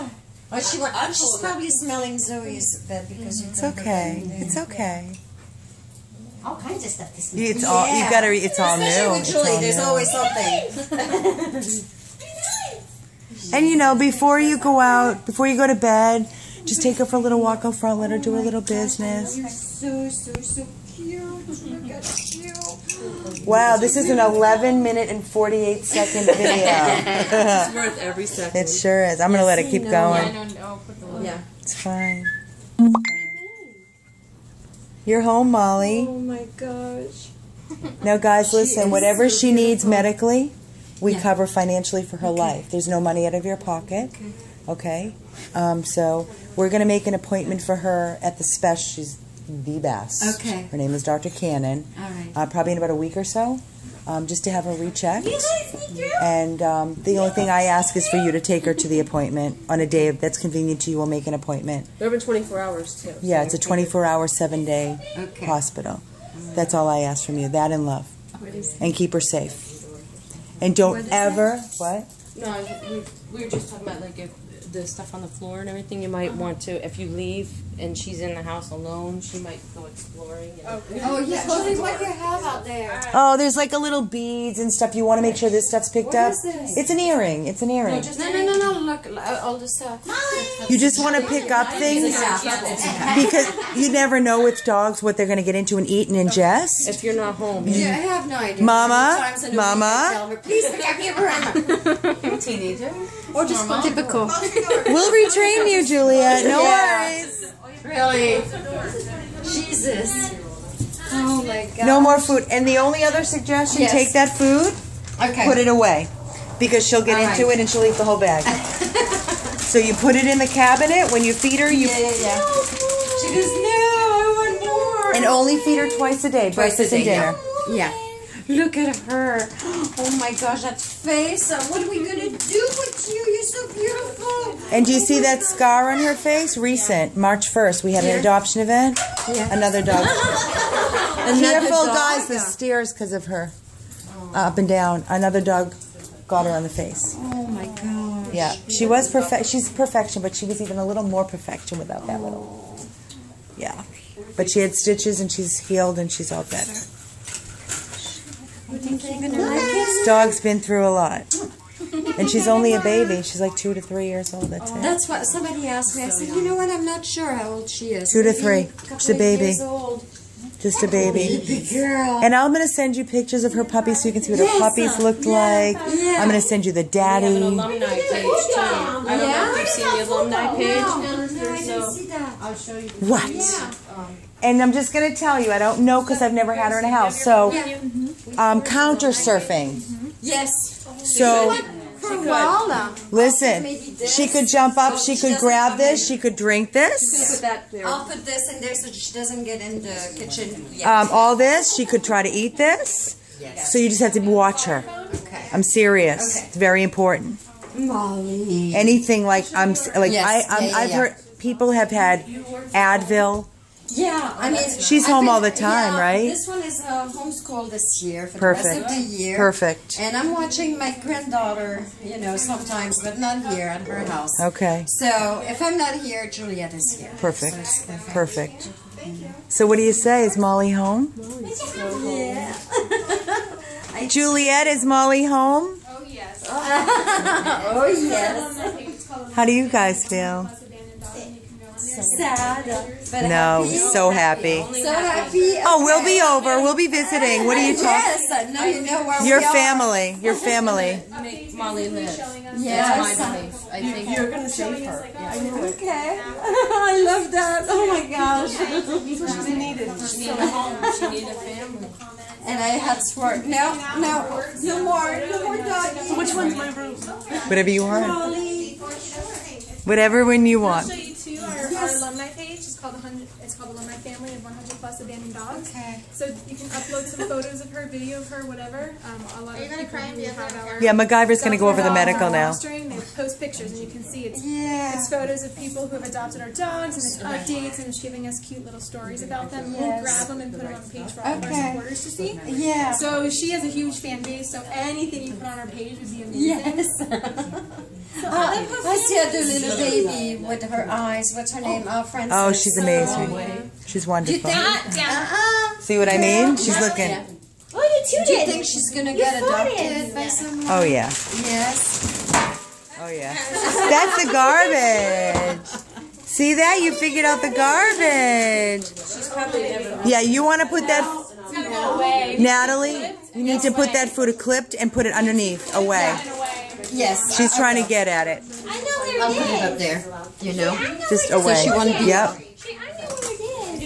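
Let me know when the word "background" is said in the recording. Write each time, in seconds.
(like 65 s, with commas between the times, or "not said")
not said.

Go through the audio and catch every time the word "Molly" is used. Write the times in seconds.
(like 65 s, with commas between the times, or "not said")
35 s, 90 s, 207 s, 230 s, 234 s, 251 s.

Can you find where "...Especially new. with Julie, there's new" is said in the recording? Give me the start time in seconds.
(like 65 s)
8 s.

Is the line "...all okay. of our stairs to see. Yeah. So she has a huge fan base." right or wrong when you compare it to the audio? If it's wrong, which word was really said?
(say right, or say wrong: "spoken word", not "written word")
wrong: "supporters", not "stairs".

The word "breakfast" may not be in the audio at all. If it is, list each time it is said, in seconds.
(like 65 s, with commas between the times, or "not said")
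126 s.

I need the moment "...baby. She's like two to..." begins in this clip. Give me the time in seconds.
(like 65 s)
162 s.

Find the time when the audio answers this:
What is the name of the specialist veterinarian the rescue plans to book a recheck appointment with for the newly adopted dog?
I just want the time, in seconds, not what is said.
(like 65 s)
51 s.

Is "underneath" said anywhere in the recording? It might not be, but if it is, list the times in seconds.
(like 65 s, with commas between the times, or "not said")
325 s.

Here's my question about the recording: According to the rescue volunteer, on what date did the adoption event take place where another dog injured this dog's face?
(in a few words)
March 1st.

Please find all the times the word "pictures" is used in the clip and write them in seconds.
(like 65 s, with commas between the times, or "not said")
173 s, 283 s.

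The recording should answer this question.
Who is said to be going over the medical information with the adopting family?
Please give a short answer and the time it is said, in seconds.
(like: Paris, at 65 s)
MacGyver, at 280 s.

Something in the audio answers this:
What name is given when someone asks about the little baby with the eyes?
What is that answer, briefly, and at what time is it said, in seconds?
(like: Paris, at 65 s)
Frances, at 302 s.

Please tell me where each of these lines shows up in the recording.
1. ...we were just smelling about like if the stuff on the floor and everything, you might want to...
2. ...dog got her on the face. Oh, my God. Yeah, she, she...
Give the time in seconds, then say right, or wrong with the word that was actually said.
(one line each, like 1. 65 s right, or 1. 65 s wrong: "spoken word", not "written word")
1. 73 s wrong: "talking", not "smelling"
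2. 145 s right.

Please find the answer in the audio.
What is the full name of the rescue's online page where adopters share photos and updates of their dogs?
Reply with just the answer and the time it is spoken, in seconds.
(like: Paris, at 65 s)
Alumni Family of 100 Plus Abandoned Dogs, at 273 s.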